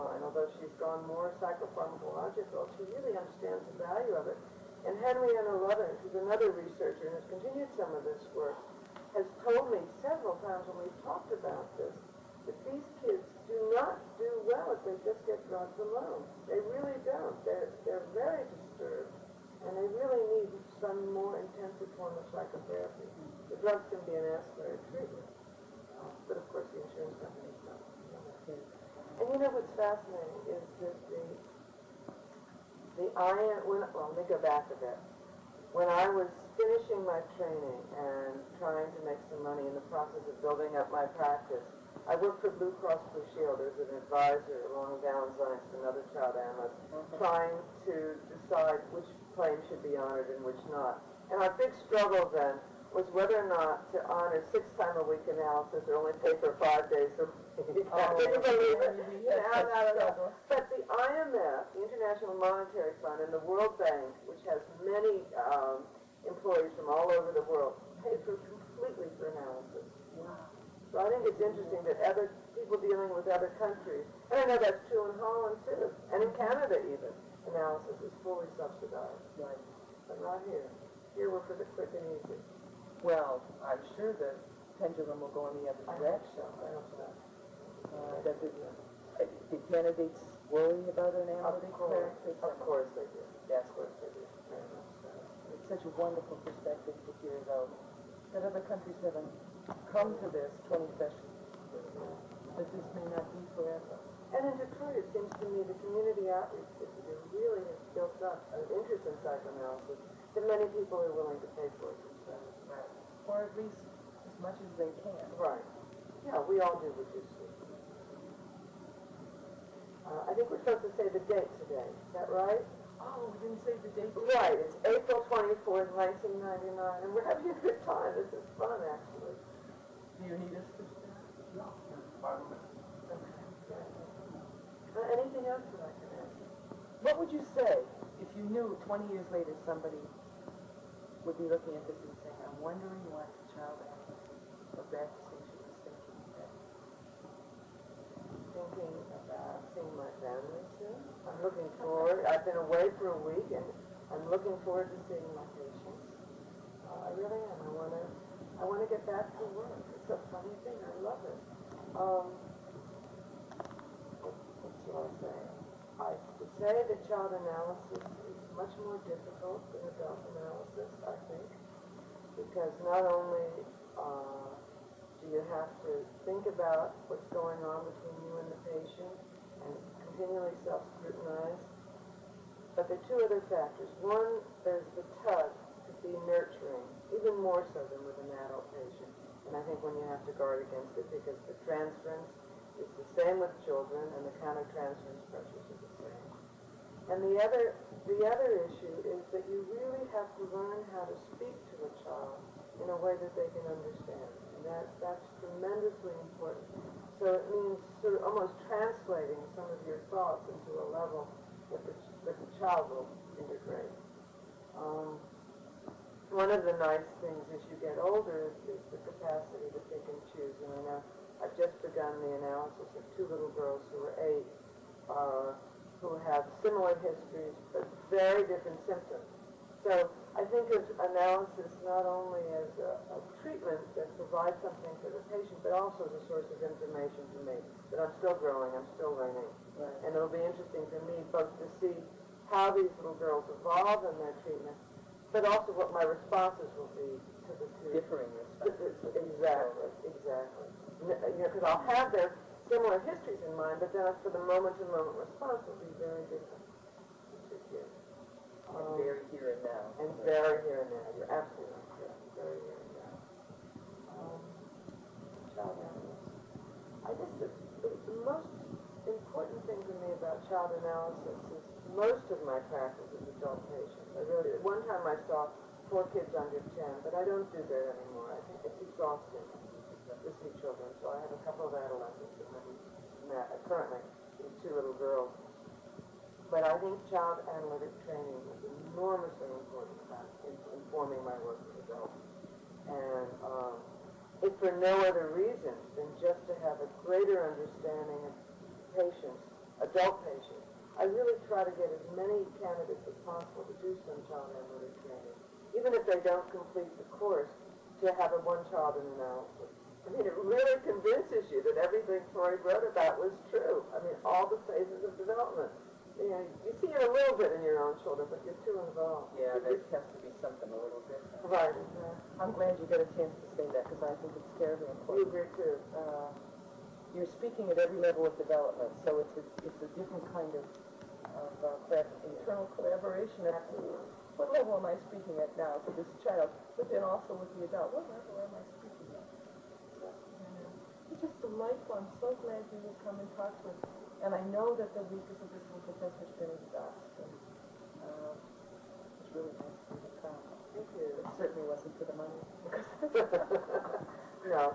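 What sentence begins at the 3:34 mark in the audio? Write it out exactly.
Um, one of the nice things as you get older is, is the capacity to pick and choose.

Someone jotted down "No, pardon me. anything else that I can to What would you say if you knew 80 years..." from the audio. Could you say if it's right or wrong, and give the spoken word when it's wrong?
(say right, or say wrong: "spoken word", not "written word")
wrong: "20", not "80".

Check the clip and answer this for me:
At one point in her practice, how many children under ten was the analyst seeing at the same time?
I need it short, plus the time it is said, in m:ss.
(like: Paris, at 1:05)
4, at 4:35.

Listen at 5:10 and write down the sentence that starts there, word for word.
I mean, it really convinces you that everything Freud wrote about was true.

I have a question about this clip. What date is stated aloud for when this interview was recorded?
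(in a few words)
April 24, 1999.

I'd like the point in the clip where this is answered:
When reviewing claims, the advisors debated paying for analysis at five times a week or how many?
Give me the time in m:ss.
0:54.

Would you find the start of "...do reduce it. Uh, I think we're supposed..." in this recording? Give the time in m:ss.
1:56.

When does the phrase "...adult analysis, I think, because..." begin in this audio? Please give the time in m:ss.
2:49.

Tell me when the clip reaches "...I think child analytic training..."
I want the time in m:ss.
4:46.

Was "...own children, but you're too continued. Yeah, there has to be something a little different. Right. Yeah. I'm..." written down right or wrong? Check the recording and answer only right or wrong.
wrong.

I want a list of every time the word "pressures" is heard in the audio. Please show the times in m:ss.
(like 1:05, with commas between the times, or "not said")
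3:15.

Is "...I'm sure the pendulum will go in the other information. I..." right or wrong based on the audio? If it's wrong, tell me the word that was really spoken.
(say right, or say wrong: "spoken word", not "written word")
wrong: "direction", not "information".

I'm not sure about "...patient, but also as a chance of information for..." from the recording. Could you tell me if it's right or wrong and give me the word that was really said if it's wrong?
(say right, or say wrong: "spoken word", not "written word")
wrong: "source", not "chance".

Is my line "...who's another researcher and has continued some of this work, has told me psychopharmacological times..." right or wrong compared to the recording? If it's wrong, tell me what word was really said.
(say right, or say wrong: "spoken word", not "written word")
wrong: "several", not "psychopharmacological".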